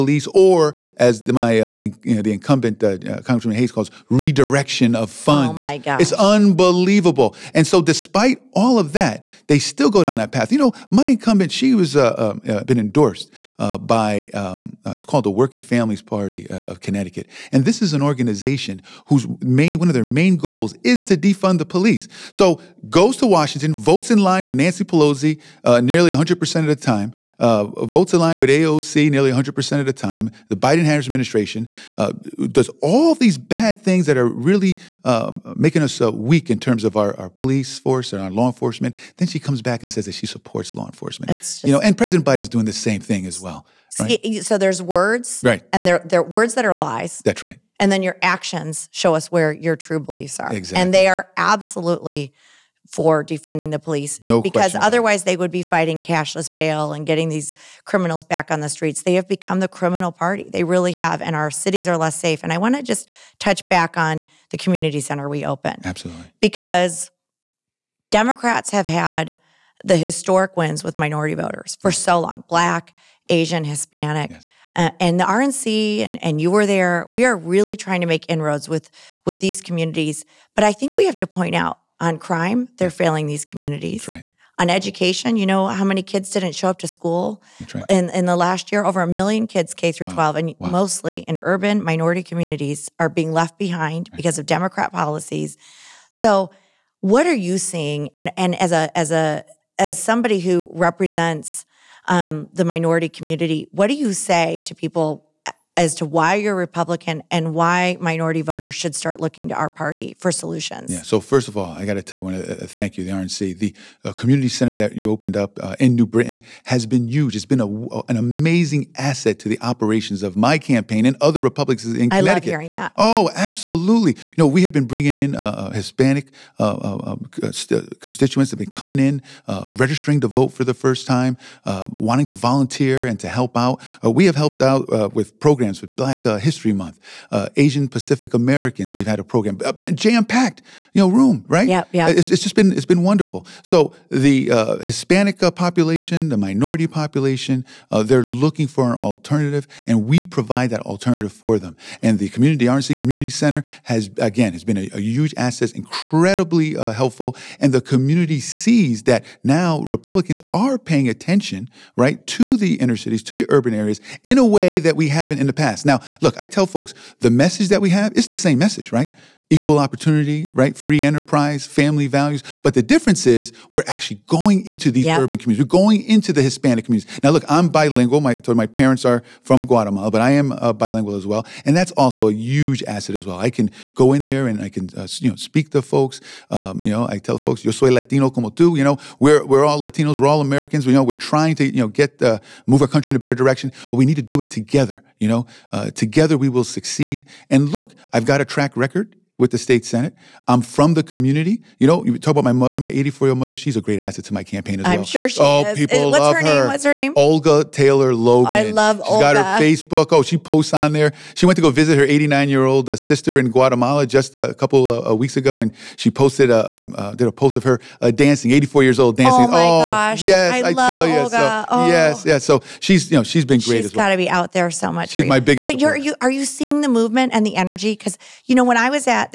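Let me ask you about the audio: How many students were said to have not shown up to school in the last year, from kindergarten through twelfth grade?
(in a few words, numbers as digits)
Over a million.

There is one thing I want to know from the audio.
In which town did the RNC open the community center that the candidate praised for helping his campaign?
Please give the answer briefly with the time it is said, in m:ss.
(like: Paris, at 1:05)
New Britain, at 1:55.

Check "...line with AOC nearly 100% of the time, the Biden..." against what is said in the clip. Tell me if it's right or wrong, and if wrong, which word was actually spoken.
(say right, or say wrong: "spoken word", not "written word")
right.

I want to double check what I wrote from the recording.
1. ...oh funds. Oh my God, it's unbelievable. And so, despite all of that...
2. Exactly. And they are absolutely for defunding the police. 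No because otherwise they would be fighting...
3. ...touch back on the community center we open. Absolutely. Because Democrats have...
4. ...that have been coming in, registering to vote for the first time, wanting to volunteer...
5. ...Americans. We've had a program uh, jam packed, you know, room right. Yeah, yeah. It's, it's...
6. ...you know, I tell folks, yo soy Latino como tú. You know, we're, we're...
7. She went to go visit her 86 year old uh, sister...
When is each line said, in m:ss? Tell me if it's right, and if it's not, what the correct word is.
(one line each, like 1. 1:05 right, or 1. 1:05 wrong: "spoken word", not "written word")
1. 0:05 right
2. 0:50 right
3. 1:03 right
4. 2:08 right
5. 2:18 right
6. 3:06 right
7. 3:31 wrong: "89", not "86".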